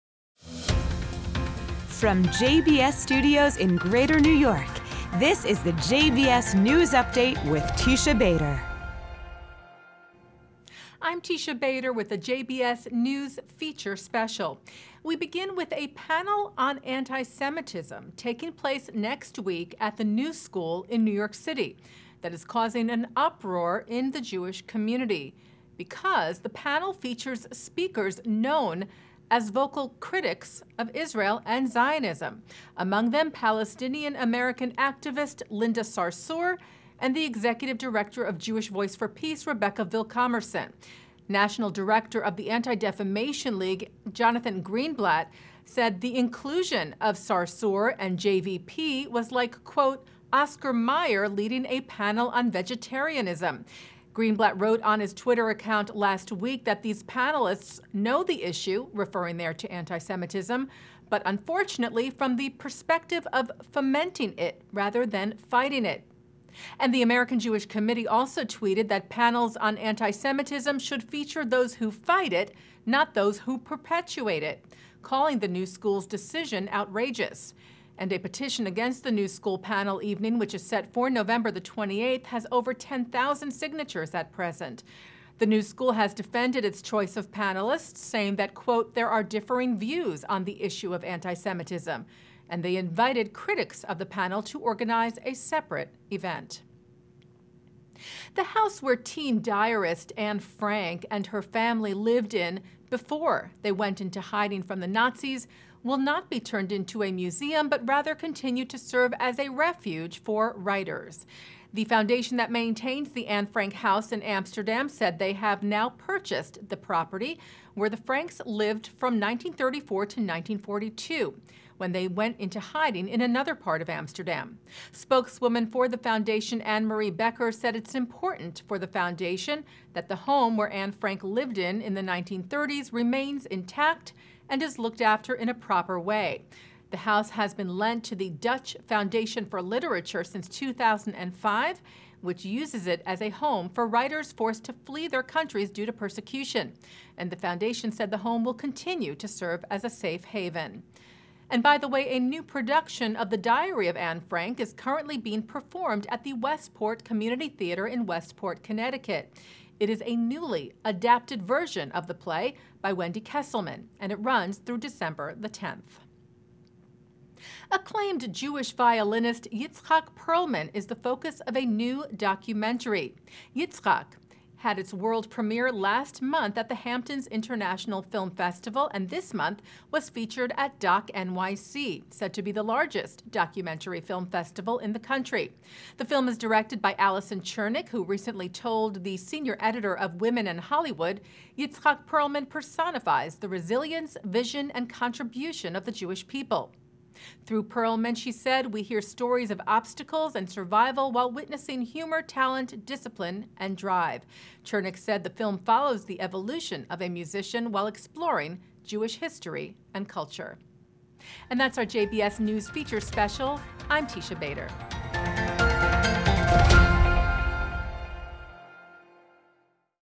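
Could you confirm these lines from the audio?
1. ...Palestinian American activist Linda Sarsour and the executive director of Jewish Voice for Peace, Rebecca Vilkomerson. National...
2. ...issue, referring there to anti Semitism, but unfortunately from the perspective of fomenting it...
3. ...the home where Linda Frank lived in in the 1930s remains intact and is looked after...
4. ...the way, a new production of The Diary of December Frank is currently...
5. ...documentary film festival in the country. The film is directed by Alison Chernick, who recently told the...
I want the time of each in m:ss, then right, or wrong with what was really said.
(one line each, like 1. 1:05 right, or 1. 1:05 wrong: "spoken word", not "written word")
1. 0:33 right
2. 0:58 right
3. 2:10 wrong: "Anne", not "Linda"
4. 2:31 wrong: "Anne", not "December"
5. 3:03 right.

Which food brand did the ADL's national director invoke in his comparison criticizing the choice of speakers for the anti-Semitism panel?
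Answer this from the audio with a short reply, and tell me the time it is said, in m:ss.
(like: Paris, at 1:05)
Oscar Mayer, at 0:50.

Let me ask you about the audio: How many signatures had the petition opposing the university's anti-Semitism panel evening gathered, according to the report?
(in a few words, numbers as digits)
10,000.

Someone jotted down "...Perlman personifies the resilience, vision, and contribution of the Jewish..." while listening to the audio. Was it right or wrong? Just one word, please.
right.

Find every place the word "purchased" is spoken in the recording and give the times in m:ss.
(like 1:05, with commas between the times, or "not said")
1:55.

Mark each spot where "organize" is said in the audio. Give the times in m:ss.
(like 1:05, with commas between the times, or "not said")
1:34.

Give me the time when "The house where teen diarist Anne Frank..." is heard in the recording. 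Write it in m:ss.
1:38.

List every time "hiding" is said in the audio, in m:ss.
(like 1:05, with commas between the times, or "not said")
1:44, 2:02.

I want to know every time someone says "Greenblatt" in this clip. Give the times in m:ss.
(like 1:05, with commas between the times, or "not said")
0:44, 0:54.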